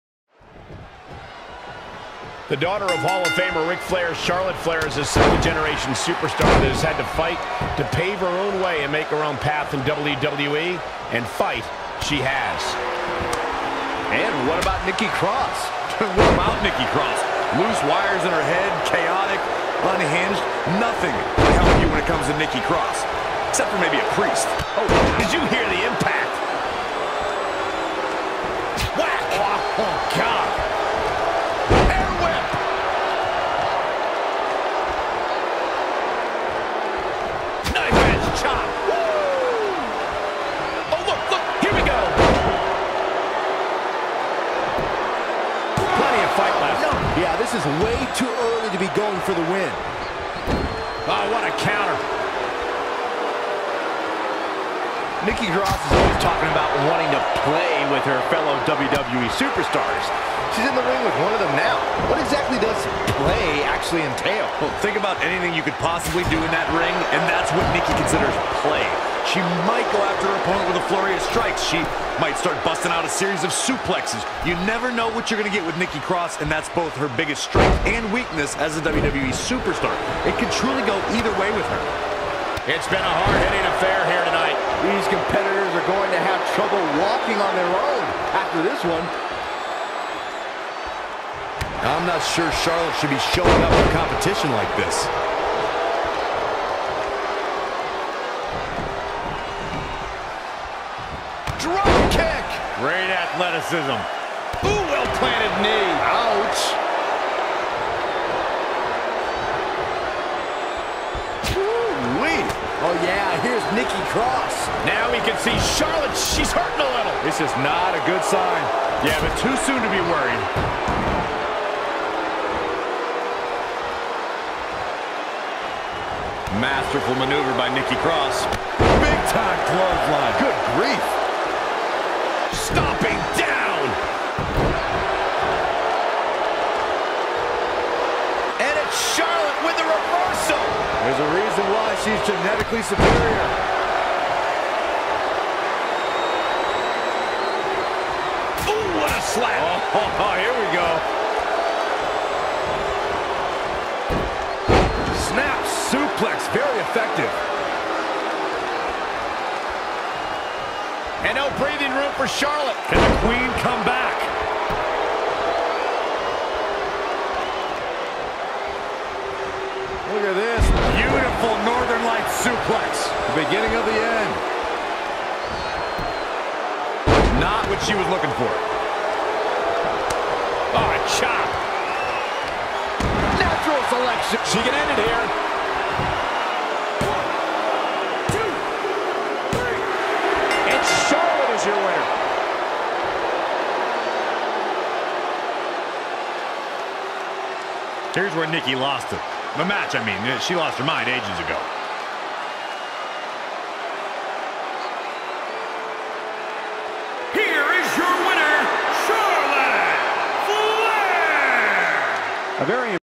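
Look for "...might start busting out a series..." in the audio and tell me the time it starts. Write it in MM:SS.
01:12.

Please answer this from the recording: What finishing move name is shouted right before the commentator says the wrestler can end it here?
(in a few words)
Natural Selection.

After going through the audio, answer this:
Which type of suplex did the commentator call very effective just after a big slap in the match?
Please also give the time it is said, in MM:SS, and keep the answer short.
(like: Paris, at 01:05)
Snap suplex, at 02:35.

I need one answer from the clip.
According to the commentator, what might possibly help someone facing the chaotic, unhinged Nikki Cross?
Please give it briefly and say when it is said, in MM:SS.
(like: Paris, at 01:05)
A priest, at 00:23.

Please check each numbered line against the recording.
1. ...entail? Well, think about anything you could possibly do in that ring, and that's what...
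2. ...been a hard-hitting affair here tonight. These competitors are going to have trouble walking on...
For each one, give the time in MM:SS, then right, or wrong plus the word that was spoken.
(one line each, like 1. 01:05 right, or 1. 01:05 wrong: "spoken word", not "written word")
1. 01:04 right
2. 01:22 right.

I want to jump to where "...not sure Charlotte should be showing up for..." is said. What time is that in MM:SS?
01:32.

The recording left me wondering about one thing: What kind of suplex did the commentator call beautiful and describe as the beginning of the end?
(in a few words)
Northern Light suplex.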